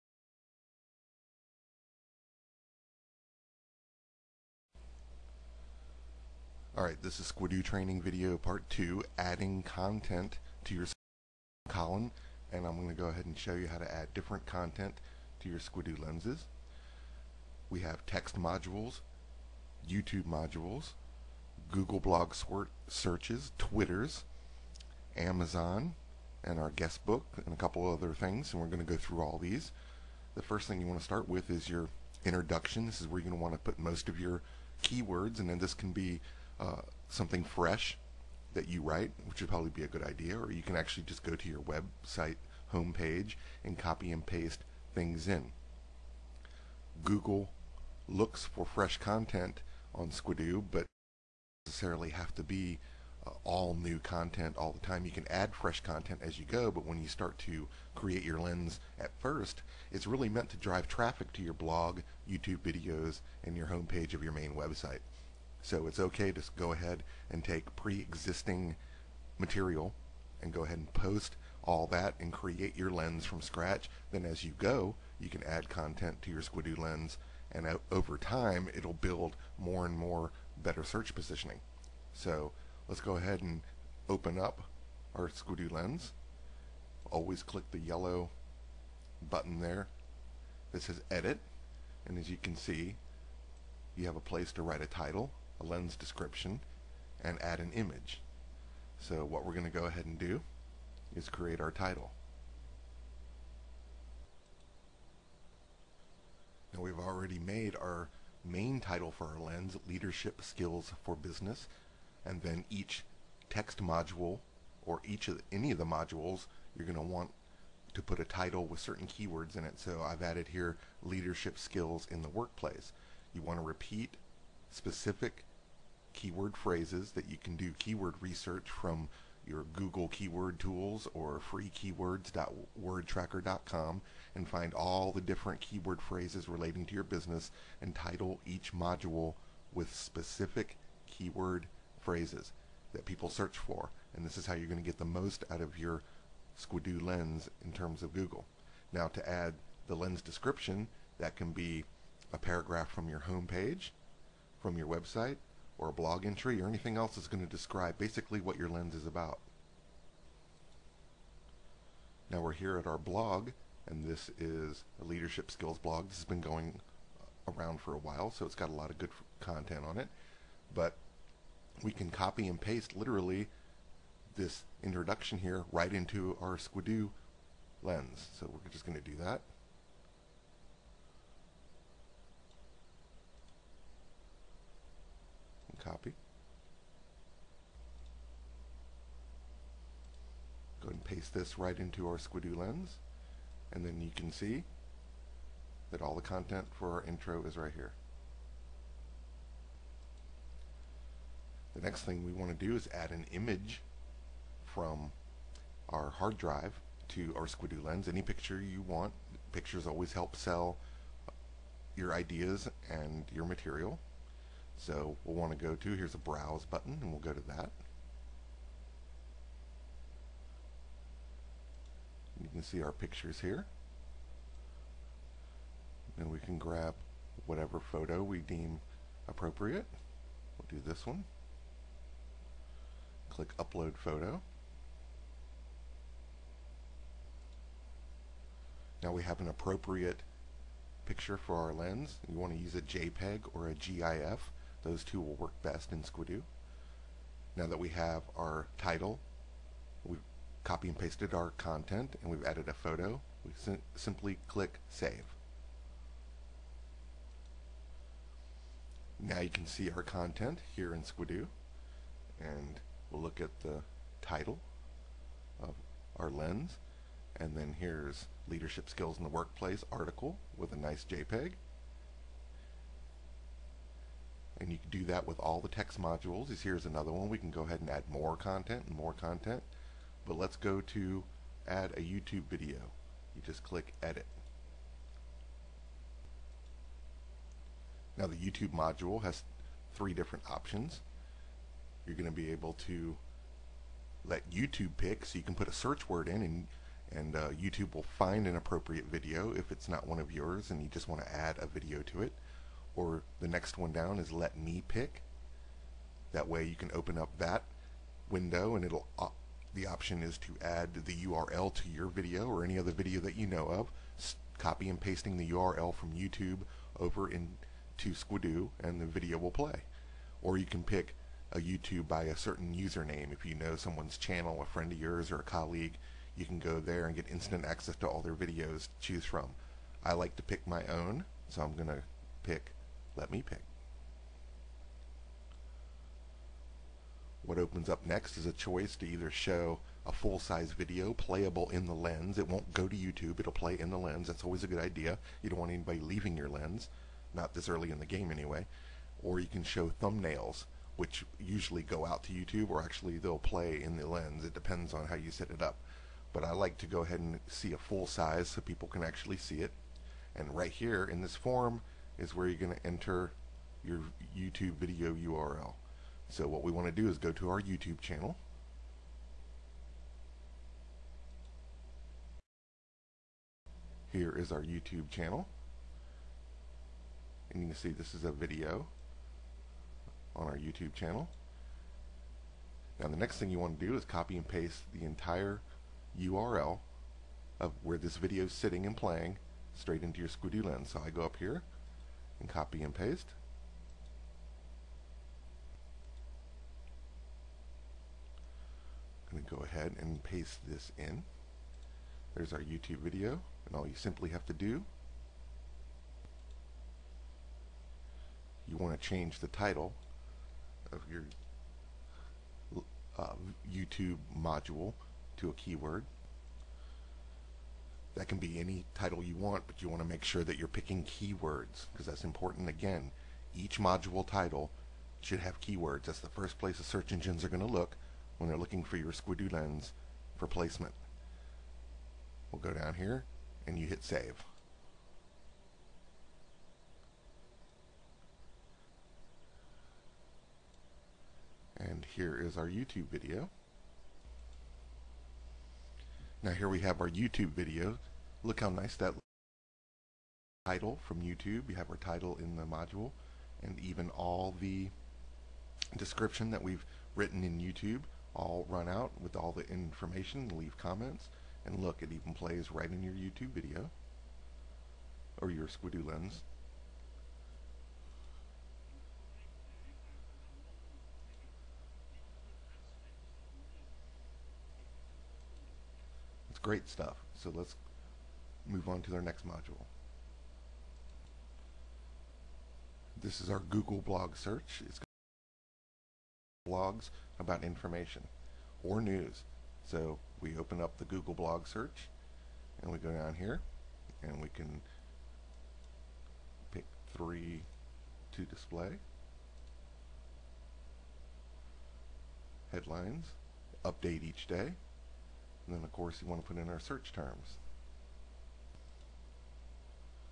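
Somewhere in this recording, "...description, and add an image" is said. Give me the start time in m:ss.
1:35.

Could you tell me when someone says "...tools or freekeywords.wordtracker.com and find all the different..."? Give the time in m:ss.
2:10.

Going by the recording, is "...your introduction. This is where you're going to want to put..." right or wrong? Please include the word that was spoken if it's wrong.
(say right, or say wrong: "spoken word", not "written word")
right.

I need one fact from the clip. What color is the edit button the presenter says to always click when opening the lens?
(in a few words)
Yellow.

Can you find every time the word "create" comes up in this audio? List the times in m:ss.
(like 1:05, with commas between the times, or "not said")
0:57, 1:12, 1:41.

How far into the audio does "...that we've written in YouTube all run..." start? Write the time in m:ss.
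7:36.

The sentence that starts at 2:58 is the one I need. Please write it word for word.
So we're just going to do that.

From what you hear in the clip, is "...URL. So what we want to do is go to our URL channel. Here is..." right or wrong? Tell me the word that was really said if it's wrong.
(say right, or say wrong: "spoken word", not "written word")
wrong: "YouTube", not "URL".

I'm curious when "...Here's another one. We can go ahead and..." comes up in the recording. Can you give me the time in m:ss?
4:36.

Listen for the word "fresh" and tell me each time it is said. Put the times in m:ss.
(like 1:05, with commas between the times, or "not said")
0:37, 0:48, 0:55.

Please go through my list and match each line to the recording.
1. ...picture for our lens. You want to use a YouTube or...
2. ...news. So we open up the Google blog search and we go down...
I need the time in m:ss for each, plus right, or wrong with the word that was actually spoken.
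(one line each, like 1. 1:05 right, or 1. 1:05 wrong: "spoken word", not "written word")
1. 4:01 wrong: "JPEG", not "YouTube"
2. 8:09 right.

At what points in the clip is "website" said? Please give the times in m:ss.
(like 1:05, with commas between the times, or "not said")
0:41, 1:04, 2:34.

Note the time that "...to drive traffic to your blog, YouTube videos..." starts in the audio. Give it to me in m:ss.
1:00.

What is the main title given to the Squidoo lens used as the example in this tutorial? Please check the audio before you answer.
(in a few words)
Leadership Skills for Business.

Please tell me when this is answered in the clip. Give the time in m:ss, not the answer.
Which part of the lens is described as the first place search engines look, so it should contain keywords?
7:03.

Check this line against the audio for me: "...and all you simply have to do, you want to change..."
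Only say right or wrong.
right.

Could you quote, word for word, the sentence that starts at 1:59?
So I've added here leadership skills in the workplace.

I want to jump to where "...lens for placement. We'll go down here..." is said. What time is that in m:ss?
7:09.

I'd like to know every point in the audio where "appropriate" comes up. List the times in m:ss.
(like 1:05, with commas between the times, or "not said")
3:49, 3:59, 4:58.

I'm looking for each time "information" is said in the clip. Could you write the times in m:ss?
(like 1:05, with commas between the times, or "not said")
7:39, 8:07.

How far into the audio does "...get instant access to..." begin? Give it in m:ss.
5:27.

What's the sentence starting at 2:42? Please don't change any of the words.
Now we're here at our blog, and this is a leadership skills blog.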